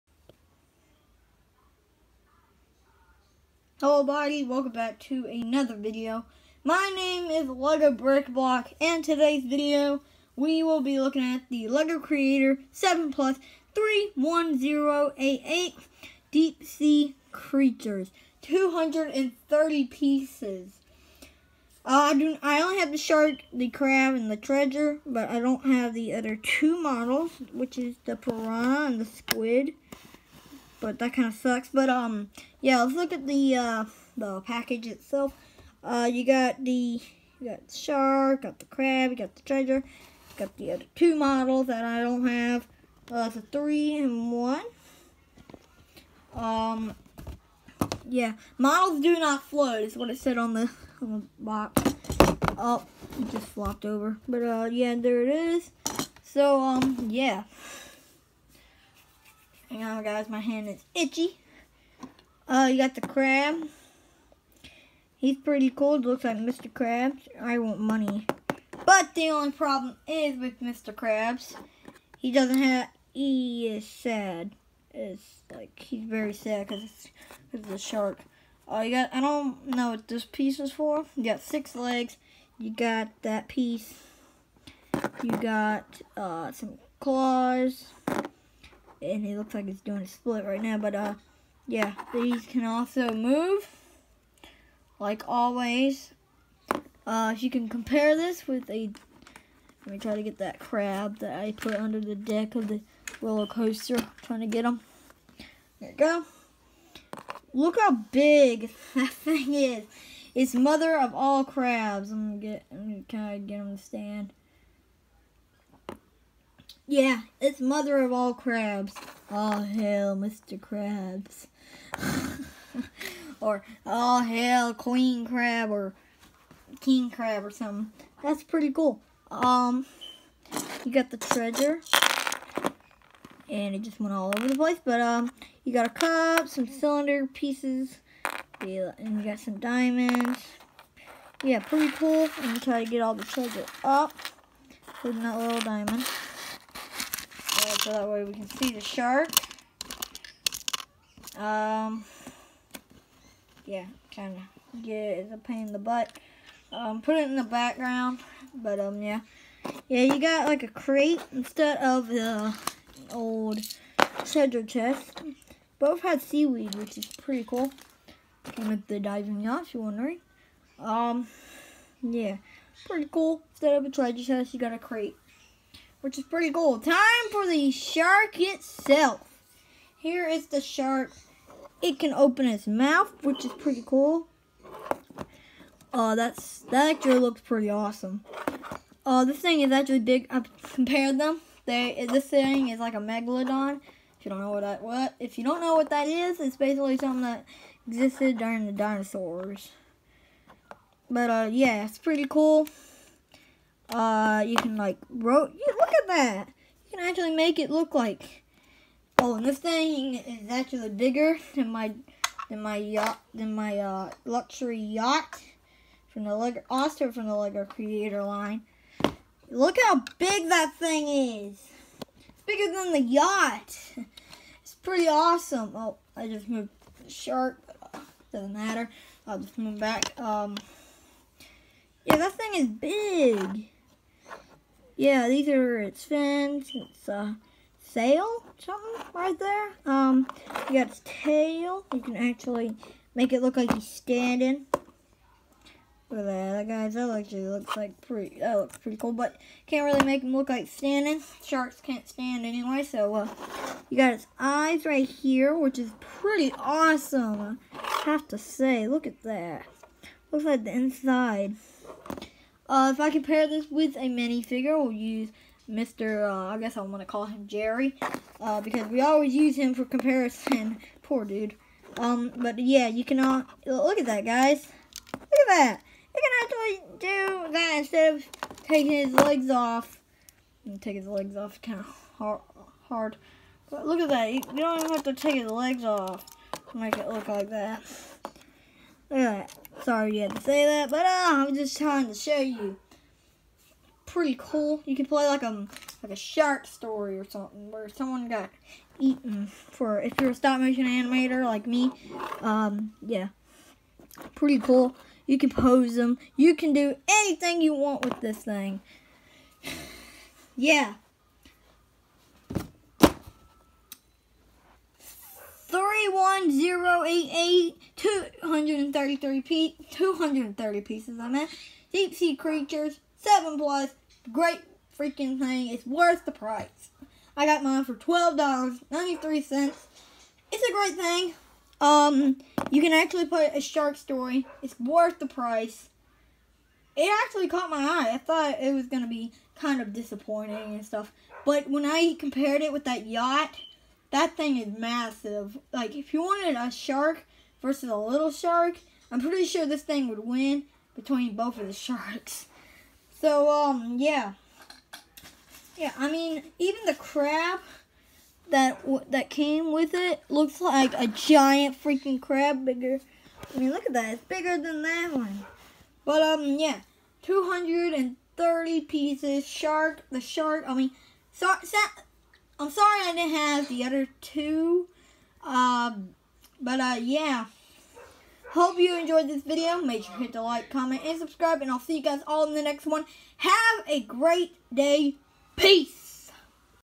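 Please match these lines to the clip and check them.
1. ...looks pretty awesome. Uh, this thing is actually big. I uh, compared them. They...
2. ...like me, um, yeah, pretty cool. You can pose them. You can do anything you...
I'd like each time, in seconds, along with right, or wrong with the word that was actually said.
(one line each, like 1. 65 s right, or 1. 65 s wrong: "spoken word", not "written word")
1. 187 s right
2. 301 s right.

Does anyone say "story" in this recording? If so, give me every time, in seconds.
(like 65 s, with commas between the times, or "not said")
296 s, 333 s.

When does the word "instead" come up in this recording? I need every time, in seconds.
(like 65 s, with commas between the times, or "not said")
161 s, 173 s, 277 s.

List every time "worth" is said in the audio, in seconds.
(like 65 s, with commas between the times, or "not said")
325 s, 334 s.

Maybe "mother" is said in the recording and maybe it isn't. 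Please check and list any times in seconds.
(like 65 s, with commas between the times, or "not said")
110 s, 117 s.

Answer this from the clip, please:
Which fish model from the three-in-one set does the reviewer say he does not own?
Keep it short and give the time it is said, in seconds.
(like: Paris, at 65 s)
piranha, at 28 s.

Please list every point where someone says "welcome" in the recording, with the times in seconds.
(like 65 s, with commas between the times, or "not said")
4 s.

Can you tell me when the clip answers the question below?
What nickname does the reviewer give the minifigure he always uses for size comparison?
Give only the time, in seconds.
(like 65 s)
267 s.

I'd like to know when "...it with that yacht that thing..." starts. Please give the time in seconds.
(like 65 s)
342 s.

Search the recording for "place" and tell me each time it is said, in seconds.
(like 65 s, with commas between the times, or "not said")
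134 s.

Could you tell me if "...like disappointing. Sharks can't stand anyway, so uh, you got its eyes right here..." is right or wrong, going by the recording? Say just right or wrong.
wrong.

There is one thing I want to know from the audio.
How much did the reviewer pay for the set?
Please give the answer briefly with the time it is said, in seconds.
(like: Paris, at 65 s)
$12.93, at 327 s.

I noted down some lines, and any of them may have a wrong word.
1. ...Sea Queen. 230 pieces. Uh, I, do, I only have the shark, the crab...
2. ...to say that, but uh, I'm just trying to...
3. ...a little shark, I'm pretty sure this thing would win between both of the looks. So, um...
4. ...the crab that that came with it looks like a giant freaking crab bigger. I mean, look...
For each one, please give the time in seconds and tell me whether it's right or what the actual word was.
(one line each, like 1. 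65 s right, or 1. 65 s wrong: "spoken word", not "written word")
1. 16 s wrong: "Creatures", not "Queen"
2. 290 s right
3. 347 s wrong: "sharks", not "looks"
4. 356 s right.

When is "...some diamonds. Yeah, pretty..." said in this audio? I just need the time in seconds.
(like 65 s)
139 s.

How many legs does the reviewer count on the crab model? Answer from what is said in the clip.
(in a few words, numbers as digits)
6.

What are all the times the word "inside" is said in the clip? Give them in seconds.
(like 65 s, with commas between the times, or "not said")
260 s.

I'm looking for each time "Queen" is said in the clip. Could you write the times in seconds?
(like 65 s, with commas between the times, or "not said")
124 s.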